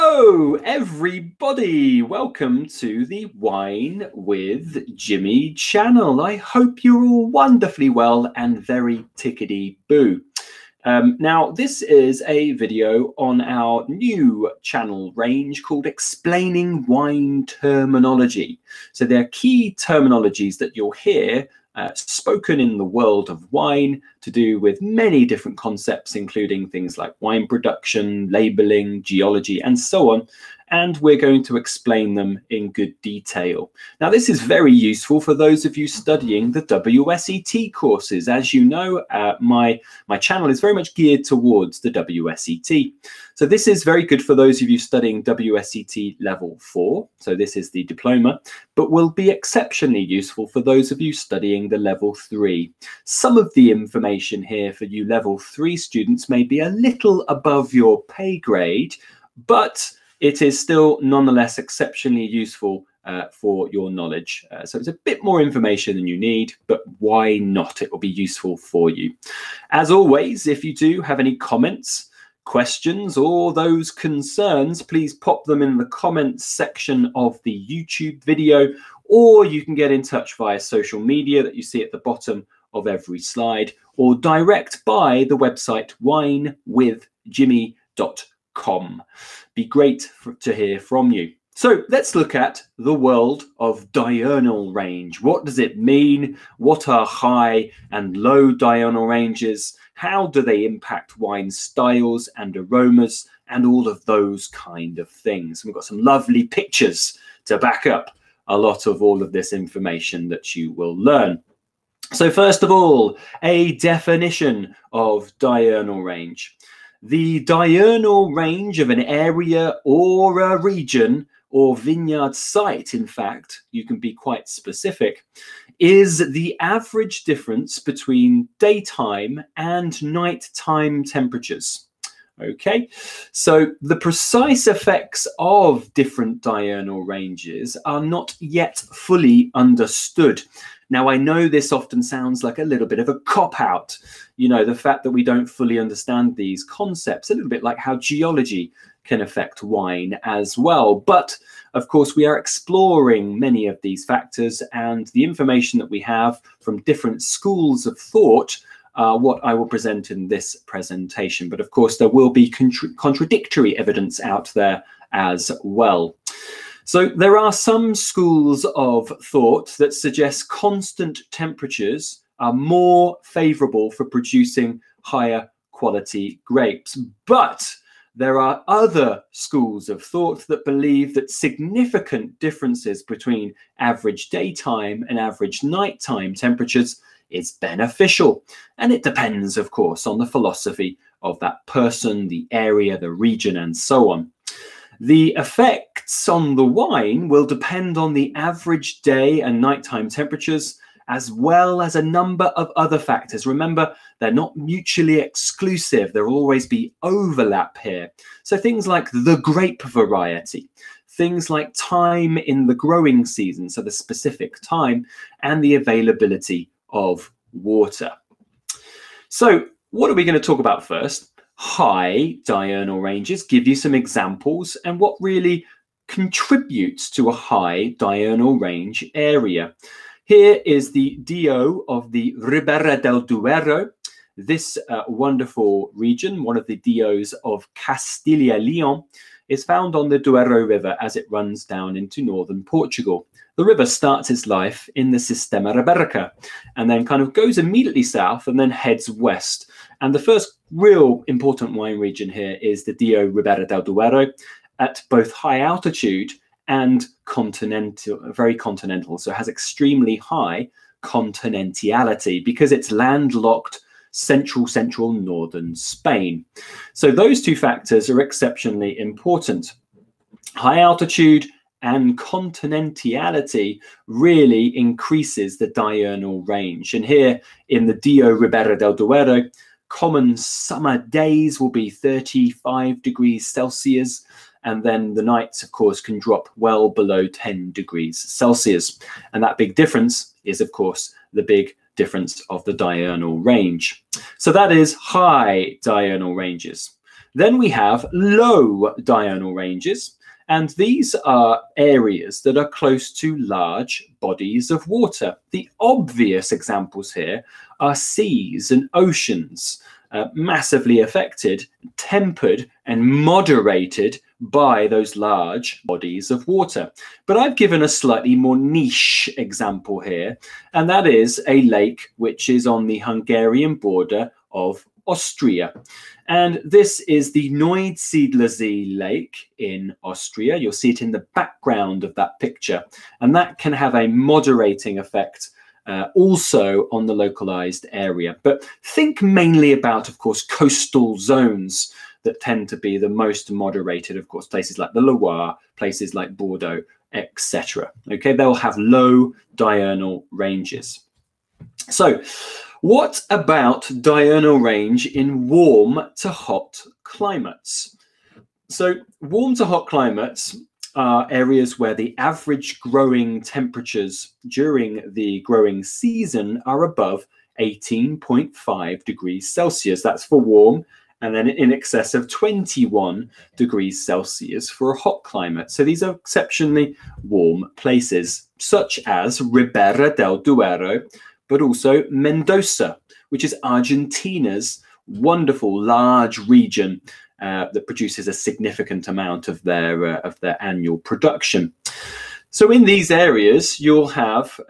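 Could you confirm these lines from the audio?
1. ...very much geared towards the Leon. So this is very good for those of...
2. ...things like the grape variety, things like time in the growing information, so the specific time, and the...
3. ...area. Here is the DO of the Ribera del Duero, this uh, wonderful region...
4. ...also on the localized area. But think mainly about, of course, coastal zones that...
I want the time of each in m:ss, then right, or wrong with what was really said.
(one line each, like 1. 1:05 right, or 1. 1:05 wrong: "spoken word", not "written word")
1. 0:40 wrong: "WSET", not "Leon"
2. 3:28 wrong: "season", not "information"
3. 3:49 right
4. 5:36 right.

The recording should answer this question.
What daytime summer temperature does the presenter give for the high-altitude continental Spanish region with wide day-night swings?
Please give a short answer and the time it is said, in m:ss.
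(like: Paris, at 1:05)
35 degrees Celsius, at 4:41.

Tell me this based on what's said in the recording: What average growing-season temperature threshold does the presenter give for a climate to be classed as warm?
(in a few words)
18.5 degrees Celsius.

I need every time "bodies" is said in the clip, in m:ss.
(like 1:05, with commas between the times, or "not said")
5:04, 5:15.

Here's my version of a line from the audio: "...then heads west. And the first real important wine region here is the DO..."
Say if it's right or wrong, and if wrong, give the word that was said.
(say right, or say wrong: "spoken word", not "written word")
right.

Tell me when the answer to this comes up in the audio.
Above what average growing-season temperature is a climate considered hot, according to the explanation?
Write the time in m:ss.
6:12.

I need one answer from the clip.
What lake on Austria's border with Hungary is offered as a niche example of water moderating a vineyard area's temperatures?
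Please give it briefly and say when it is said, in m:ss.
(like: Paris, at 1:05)
Neusiedlersee, at 5:27.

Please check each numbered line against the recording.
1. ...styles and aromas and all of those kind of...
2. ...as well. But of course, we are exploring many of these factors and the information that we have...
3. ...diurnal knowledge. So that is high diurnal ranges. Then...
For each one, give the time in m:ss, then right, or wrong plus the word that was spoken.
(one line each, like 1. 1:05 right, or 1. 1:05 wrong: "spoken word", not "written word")
1. 1:41 right
2. 2:30 right
3. 4:52 wrong: "range", not "knowledge".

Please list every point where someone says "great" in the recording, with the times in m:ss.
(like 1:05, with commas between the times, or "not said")
1:29.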